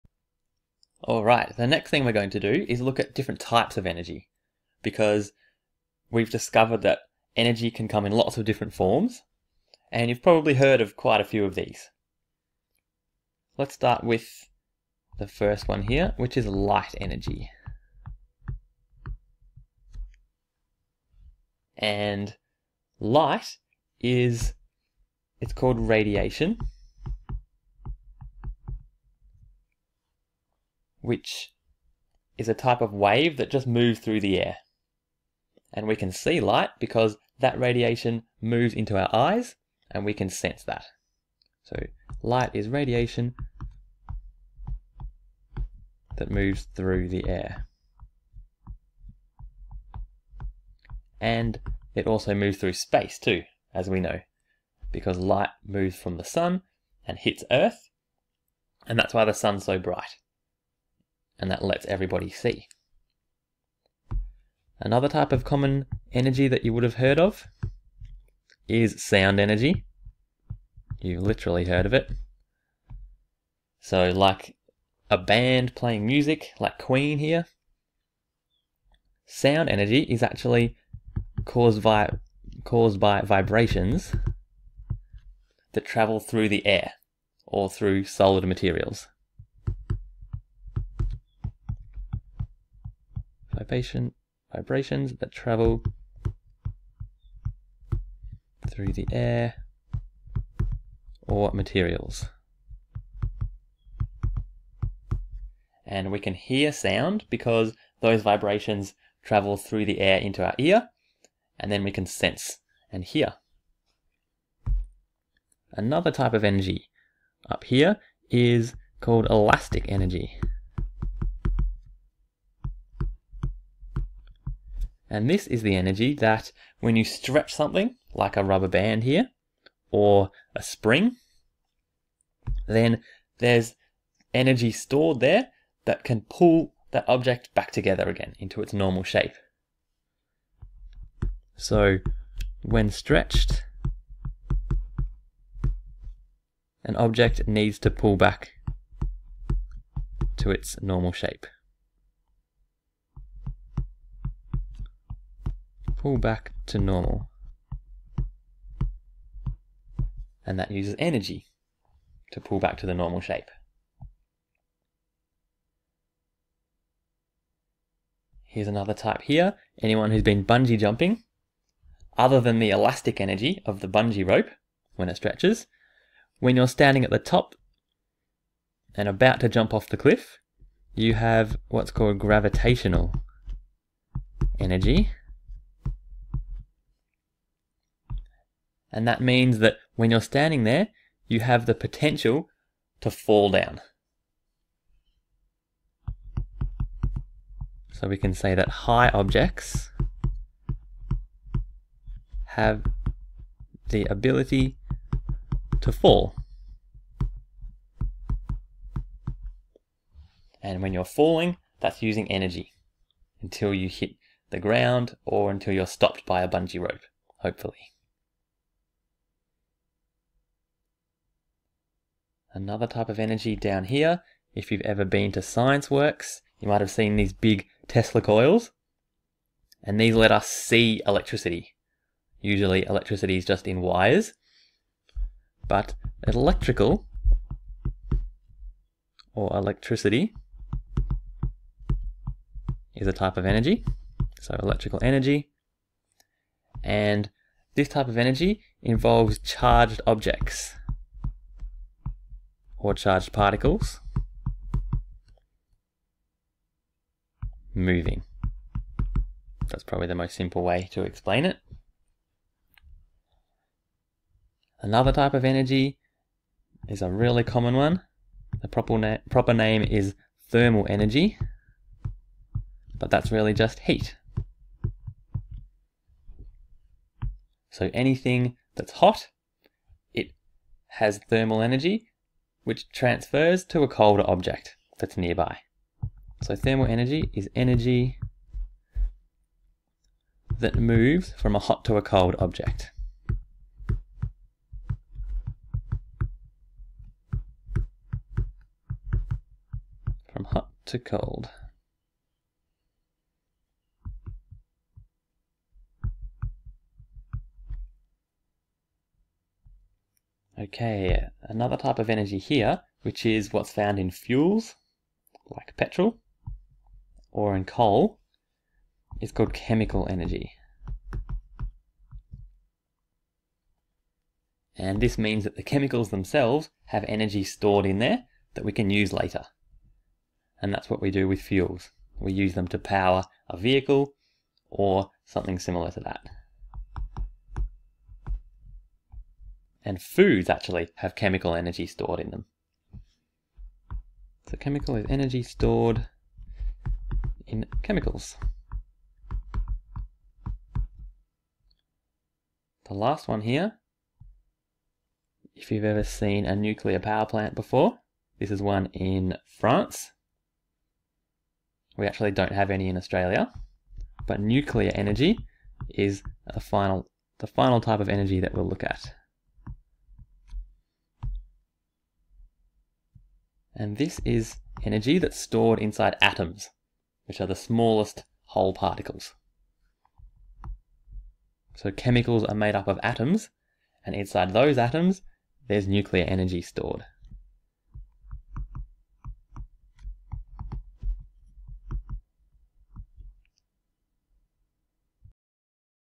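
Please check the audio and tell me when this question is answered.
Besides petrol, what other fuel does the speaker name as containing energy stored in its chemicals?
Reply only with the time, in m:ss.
5:17.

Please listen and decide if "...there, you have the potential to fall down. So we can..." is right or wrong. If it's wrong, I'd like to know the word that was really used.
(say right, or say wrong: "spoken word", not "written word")
right.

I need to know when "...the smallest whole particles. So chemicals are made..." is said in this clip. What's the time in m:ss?
6:17.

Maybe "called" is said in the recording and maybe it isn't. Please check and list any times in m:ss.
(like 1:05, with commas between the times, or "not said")
0:25, 1:59, 3:01, 5:19.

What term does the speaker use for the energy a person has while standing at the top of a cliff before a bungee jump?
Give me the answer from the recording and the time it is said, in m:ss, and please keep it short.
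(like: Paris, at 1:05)
gravitational energy, at 3:02.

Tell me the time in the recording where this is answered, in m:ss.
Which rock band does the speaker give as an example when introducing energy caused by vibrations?
1:16.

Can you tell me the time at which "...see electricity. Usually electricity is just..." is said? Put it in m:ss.
3:50.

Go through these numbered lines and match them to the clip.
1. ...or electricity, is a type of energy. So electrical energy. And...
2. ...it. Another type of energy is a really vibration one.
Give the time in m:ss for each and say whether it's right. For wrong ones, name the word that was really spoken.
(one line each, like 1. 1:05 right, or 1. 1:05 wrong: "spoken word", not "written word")
1. 3:59 right
2. 4:21 wrong: "common", not "vibration".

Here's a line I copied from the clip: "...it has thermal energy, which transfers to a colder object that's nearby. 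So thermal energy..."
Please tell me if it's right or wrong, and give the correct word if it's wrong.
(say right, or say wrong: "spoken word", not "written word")
right.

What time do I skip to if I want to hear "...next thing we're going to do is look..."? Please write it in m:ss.
0:01.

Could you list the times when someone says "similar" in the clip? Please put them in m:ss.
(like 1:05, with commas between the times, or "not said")
5:35.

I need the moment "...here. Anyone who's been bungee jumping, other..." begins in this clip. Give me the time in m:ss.
2:49.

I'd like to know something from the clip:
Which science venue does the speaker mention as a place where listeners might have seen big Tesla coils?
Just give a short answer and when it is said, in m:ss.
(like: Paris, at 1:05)
Scienceworks, at 3:45.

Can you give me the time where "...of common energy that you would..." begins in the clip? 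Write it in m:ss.
1:05.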